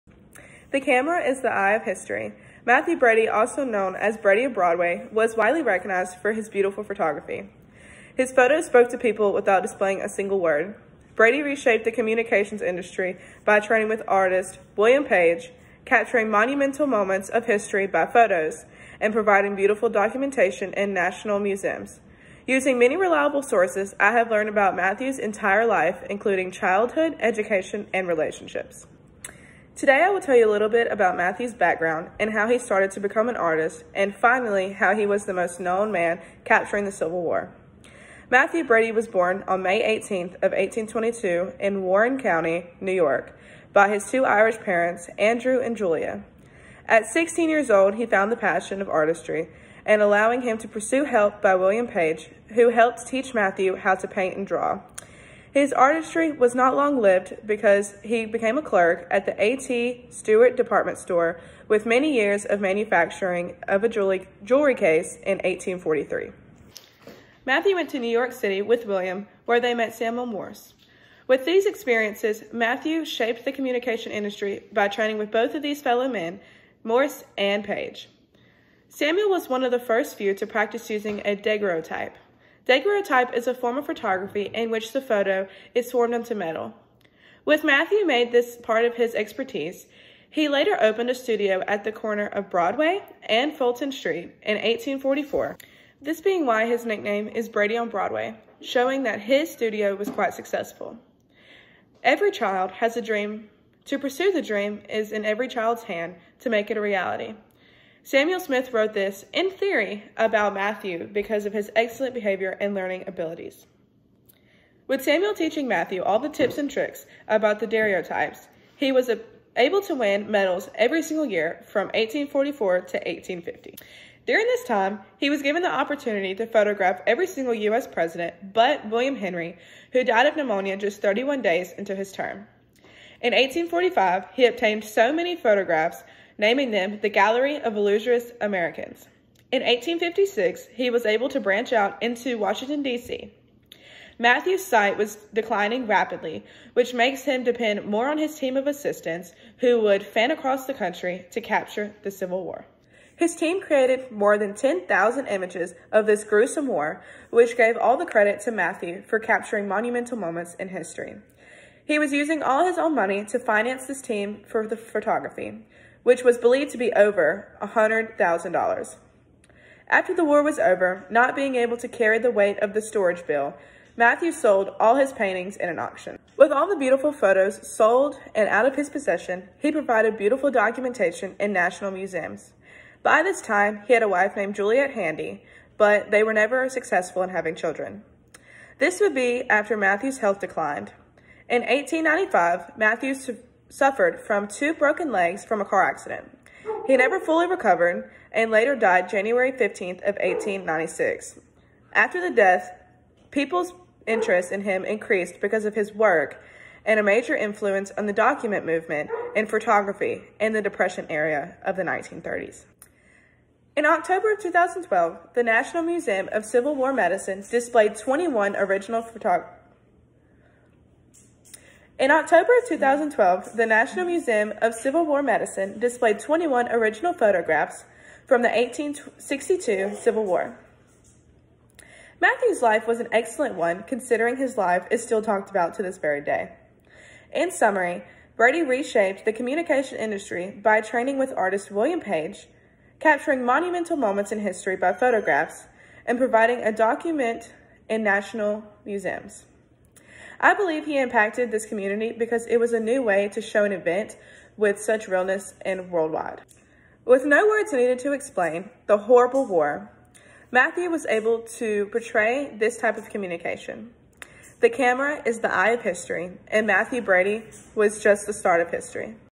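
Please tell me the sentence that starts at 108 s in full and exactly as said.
Samuel Smith wrote this, in theory, about Mathew because of his excellent behavior and learning abilities.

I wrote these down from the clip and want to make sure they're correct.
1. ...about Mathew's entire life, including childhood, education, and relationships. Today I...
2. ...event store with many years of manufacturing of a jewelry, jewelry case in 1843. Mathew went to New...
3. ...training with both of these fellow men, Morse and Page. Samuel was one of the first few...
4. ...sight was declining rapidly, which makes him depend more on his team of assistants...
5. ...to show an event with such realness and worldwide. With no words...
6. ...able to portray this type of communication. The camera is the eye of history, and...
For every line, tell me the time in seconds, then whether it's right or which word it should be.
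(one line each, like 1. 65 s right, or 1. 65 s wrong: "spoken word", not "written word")
1. 24 s right
2. 60 s wrong: "department", not "event"
3. 74 s right
4. 144 s right
5. 253 s right
6. 261 s right.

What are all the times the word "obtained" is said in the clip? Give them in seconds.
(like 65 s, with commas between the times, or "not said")
134 s.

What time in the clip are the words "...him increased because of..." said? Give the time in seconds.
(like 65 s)
204 s.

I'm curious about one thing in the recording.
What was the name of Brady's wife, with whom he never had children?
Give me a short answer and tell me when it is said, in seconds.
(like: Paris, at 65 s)
Juliet Handy, at 184 s.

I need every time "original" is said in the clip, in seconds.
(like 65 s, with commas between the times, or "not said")
218 s, 226 s.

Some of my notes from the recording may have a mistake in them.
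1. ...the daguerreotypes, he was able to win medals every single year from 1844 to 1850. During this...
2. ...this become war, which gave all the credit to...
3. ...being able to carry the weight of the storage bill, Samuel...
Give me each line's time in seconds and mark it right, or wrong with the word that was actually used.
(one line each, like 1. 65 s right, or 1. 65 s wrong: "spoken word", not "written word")
1. 117 s right
2. 156 s wrong: "gruesome", not "become"
3. 171 s wrong: "Mathew", not "Samuel".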